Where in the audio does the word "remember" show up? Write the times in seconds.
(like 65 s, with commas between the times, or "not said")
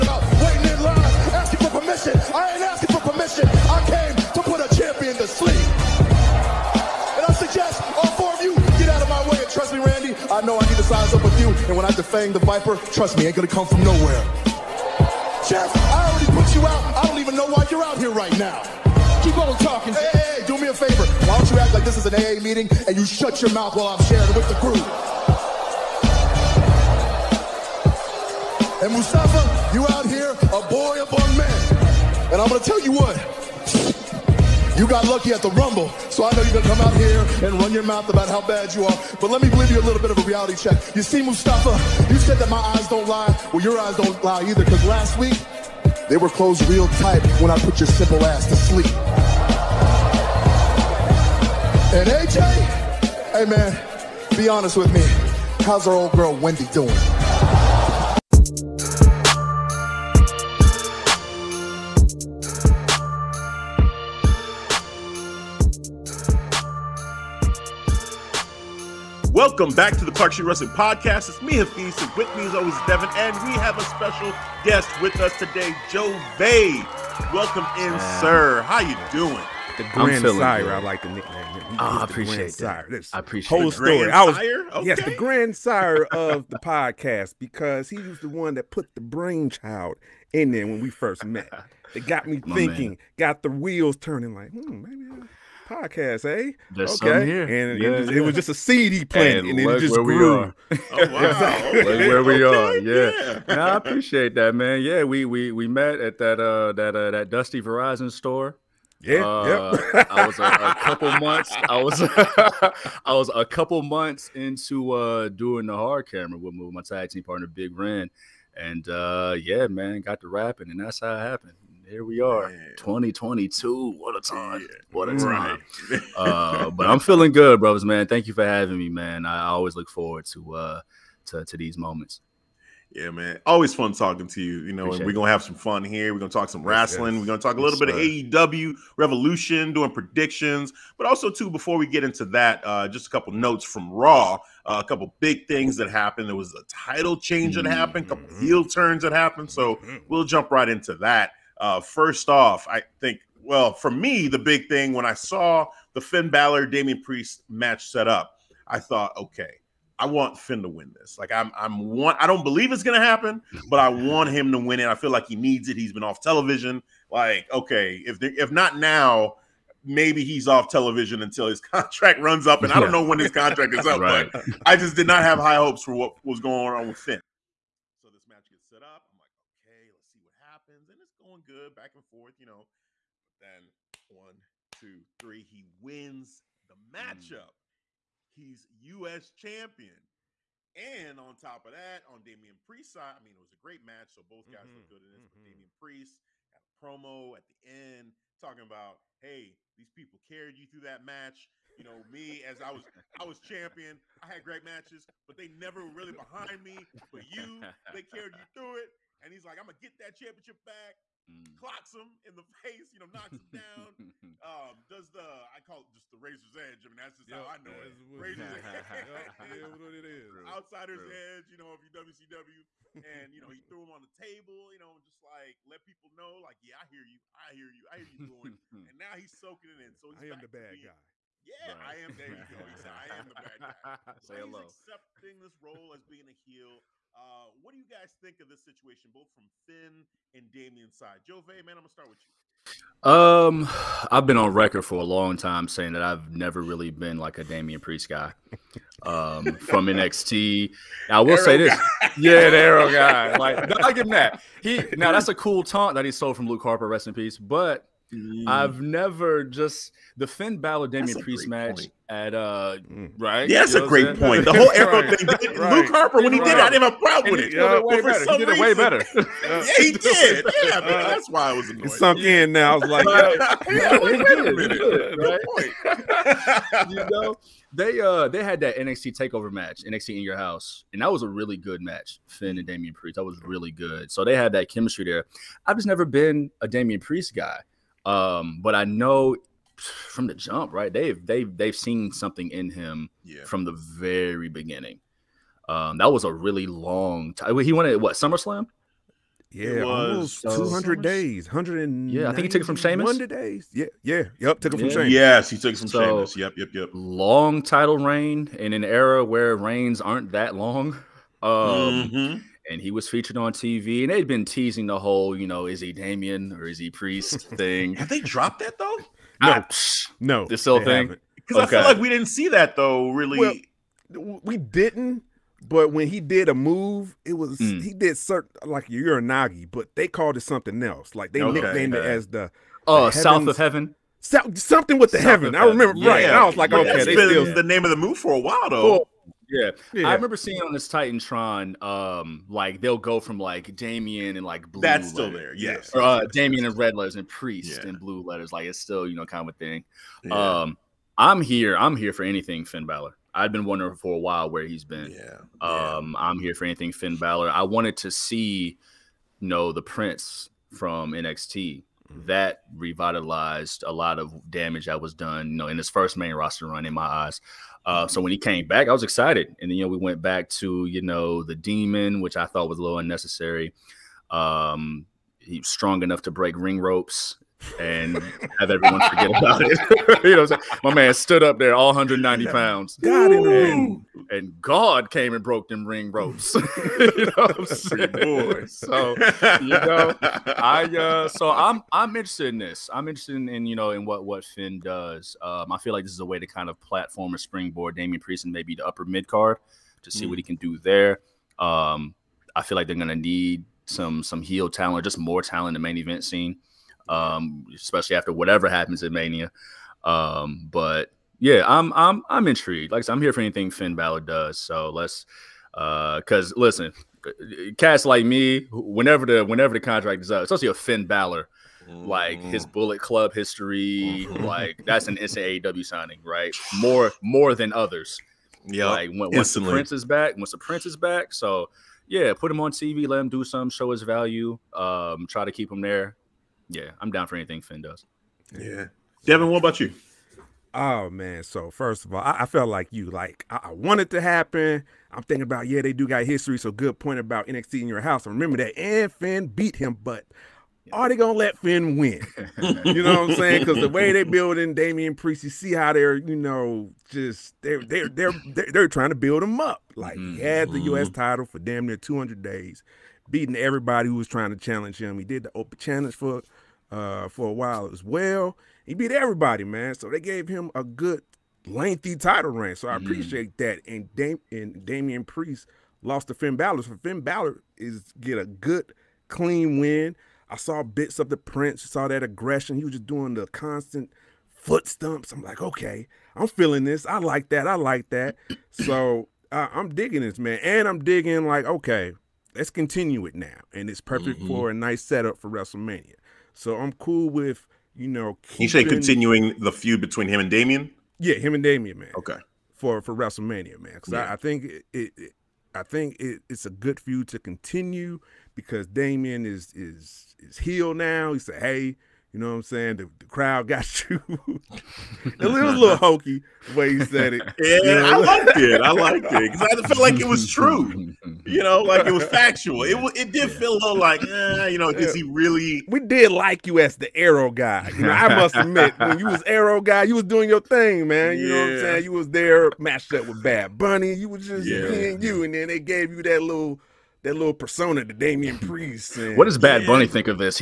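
335 s, 340 s, 448 s.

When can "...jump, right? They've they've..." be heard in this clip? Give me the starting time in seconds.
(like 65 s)
290 s.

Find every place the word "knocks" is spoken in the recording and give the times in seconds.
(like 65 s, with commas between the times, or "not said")
213 s.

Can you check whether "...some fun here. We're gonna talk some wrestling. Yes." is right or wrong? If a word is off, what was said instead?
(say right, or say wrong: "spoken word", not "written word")
right.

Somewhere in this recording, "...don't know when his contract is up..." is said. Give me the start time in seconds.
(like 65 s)
172 s.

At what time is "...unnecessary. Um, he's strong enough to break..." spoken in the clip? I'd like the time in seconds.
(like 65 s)
372 s.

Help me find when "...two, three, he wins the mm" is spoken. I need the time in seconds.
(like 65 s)
184 s.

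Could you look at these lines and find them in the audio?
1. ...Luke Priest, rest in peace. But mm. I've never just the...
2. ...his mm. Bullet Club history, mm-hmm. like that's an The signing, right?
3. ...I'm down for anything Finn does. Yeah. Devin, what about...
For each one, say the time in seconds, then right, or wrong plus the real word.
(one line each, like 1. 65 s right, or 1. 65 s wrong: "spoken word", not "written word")
1. 256 s wrong: "Harper", not "Priest"
2. 422 s wrong: "NCAW", not "The"
3. 437 s right.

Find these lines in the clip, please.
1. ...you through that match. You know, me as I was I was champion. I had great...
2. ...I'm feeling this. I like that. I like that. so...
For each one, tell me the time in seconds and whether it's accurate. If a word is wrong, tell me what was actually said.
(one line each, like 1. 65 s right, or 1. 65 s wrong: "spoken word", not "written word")
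1. 200 s right
2. 486 s right.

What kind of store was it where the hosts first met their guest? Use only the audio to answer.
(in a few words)
Verizon store.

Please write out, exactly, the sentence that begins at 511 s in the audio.
He said, "Hey, you know what I'm saying?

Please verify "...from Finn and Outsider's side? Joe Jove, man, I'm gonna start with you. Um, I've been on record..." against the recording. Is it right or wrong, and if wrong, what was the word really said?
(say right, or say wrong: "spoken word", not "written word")
wrong: "Damian", not "Outsider".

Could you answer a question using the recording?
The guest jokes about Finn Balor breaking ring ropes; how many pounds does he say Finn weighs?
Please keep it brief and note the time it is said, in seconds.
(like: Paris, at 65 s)
190, at 381 s.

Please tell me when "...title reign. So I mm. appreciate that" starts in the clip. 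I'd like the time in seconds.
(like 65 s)
472 s.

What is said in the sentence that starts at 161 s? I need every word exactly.
Like I'm, I'm one I don't believe it's gonna happen, but I want him to win it.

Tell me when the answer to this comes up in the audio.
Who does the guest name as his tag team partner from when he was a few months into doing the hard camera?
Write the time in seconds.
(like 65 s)
117 s.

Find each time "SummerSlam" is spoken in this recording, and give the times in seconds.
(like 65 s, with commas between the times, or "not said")
298 s.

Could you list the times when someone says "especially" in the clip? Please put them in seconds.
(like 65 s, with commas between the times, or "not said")
407 s, 420 s.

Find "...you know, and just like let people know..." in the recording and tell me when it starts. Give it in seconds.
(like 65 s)
224 s.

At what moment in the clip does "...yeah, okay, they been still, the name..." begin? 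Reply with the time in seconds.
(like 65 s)
336 s.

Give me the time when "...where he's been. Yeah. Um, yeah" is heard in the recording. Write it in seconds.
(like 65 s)
354 s.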